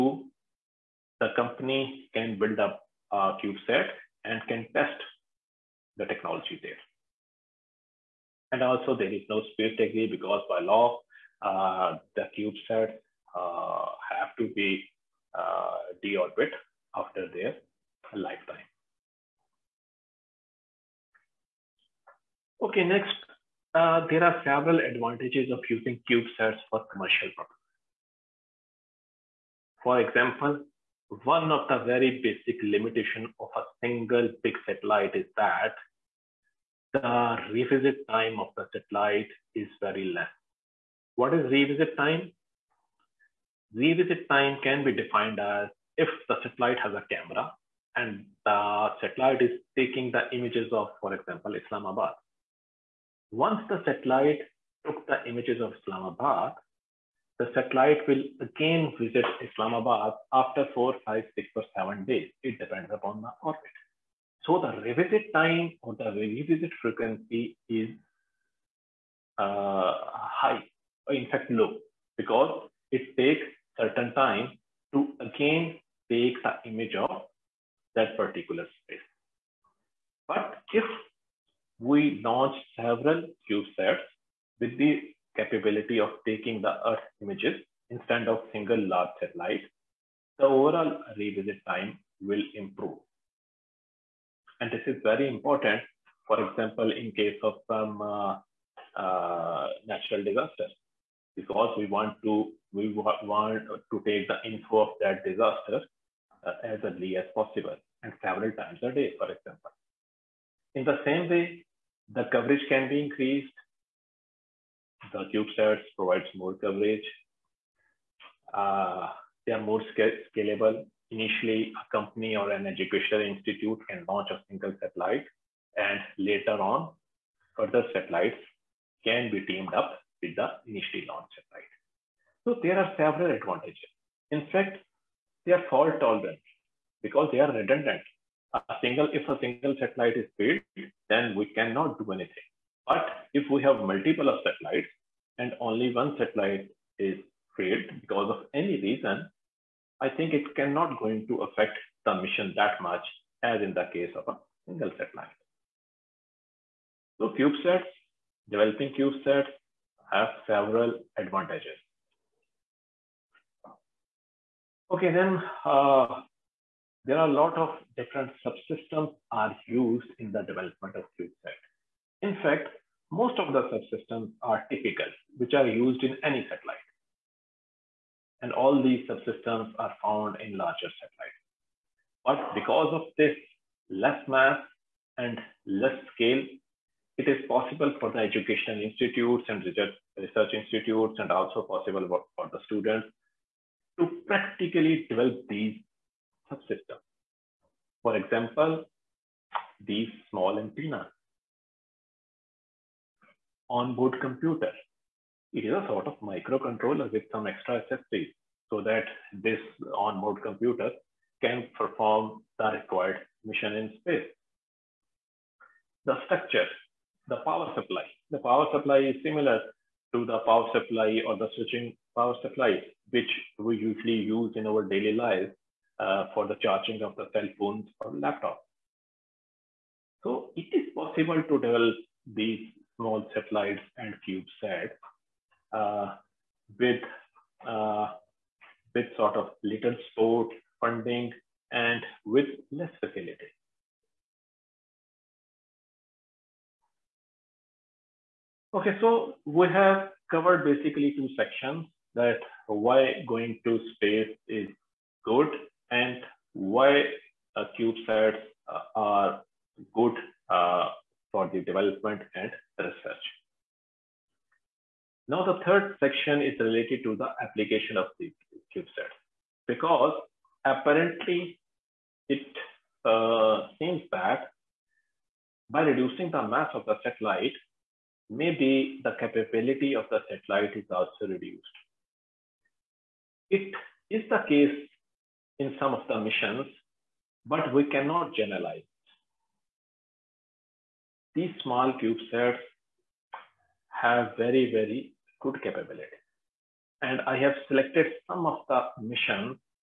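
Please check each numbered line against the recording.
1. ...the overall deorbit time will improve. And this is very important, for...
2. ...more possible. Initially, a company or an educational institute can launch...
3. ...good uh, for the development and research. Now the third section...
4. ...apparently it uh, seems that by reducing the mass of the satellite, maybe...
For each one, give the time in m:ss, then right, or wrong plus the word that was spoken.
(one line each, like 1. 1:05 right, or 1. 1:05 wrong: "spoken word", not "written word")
1. 1:30 wrong: "revisit", not "deorbit"
2. 1:59 wrong: "scalable", not "possible"
3. 4:19 right
4. 4:30 right.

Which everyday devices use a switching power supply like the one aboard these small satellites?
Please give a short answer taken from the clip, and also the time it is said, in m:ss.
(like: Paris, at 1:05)
cell phones or laptops, at 3:47.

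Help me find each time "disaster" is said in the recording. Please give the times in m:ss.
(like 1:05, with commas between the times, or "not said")
1:40, 1:45.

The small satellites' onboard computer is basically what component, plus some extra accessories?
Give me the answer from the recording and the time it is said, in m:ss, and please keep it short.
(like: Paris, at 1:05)
microcontroller, at 3:26.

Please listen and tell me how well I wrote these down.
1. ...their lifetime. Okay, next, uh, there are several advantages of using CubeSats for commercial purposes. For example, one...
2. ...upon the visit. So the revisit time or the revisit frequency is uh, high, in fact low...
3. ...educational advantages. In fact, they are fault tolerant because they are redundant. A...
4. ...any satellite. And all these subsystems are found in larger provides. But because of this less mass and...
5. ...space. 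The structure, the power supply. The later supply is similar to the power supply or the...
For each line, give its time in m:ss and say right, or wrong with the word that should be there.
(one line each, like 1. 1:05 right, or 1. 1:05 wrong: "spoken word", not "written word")
1. 0:17 right
2. 1:02 wrong: "orbit", not "visit"
3. 2:12 wrong: "several", not "educational"
4. 2:56 wrong: "satellites", not "provides"
5. 3:33 wrong: "power", not "later".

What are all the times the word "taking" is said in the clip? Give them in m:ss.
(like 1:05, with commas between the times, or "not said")
0:49, 1:26.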